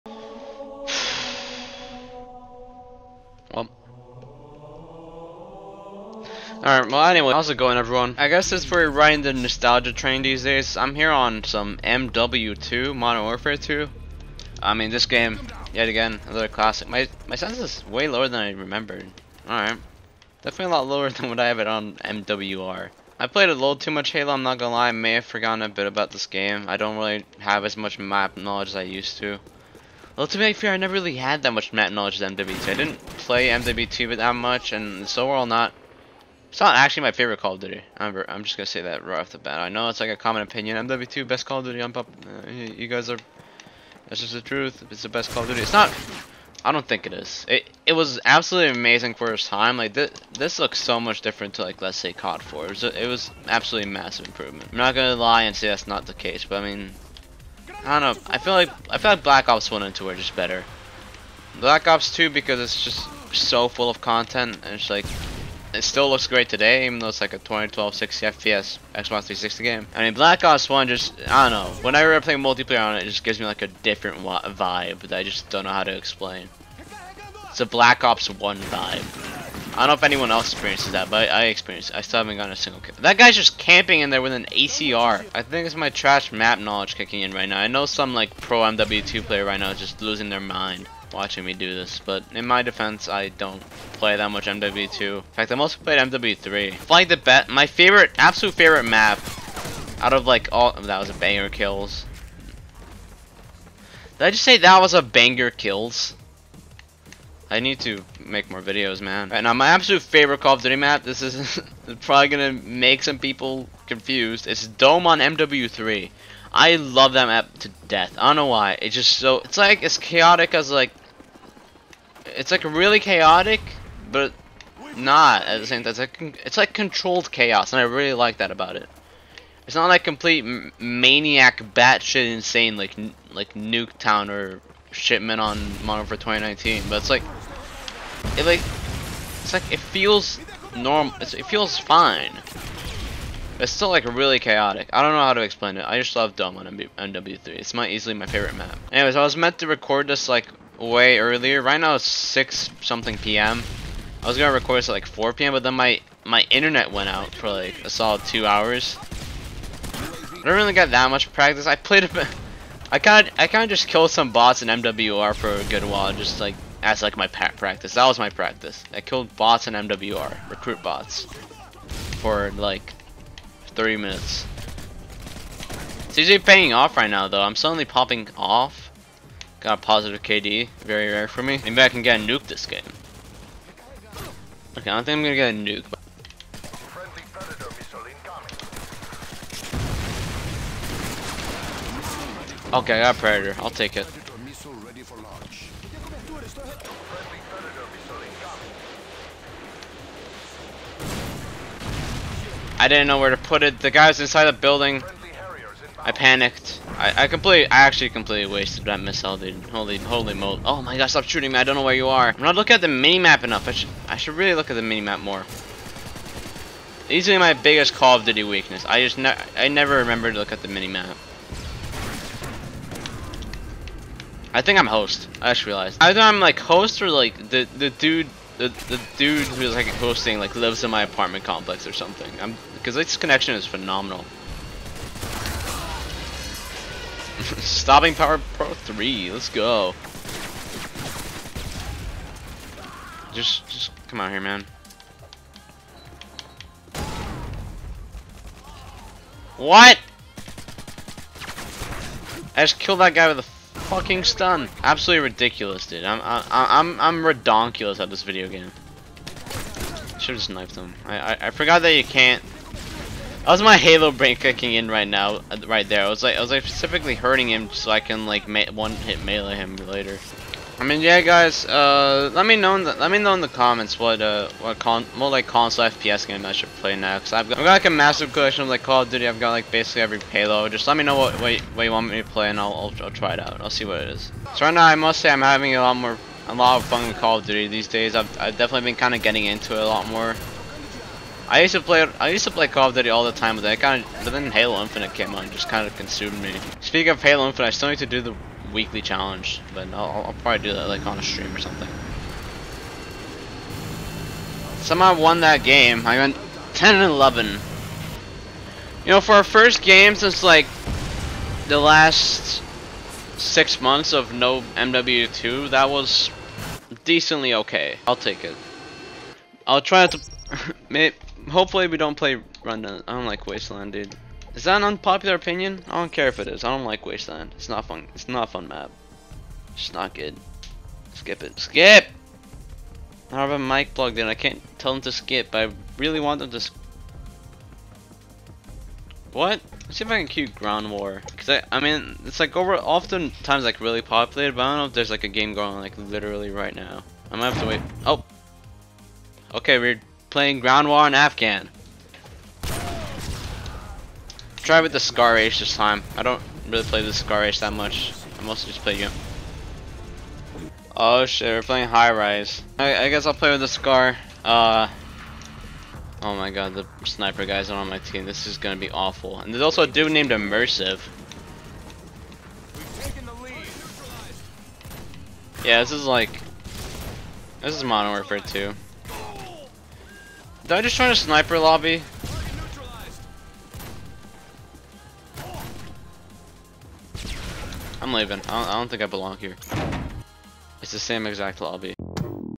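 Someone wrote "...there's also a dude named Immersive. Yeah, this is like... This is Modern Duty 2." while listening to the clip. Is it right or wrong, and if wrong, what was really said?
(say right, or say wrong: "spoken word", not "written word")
wrong: "Warfare", not "Duty".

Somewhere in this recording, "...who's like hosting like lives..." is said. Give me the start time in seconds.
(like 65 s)
229 s.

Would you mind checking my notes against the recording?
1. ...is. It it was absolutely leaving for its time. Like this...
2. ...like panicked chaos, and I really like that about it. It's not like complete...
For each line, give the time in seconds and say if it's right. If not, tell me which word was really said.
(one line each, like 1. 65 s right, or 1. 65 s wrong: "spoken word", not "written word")
1. 47 s wrong: "amazing", not "leaving"
2. 126 s wrong: "controlled", not "panicked".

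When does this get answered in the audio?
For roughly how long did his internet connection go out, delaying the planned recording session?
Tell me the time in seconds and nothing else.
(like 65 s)
158 s.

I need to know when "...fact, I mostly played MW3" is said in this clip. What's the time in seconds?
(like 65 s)
95 s.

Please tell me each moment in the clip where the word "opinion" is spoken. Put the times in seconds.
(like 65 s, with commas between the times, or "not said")
40 s, 325 s.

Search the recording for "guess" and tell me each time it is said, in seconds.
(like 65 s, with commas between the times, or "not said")
8 s, 363 s.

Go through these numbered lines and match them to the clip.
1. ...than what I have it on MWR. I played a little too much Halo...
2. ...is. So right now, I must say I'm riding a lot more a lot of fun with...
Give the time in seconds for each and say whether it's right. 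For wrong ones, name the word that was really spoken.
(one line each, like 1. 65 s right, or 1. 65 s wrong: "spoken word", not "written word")
1. 21 s right
2. 284 s wrong: "having", not "riding".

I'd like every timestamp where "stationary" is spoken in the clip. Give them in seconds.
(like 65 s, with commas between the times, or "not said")
not said.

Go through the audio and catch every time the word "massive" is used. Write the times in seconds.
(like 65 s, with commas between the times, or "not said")
53 s, 277 s.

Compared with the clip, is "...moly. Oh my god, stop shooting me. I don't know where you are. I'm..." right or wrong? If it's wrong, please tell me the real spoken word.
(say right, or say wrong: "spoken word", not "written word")
right.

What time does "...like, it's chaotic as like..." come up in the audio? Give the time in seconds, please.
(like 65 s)
119 s.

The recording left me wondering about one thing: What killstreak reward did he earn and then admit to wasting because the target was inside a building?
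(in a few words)
Predator.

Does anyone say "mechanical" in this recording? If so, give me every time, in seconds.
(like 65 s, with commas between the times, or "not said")
not said.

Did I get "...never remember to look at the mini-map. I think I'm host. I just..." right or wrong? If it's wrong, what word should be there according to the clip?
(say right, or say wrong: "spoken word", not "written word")
right.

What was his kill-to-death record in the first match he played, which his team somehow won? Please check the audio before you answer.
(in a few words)
10 and 11.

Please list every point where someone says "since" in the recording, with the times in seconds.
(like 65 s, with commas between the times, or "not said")
8 s, 310 s.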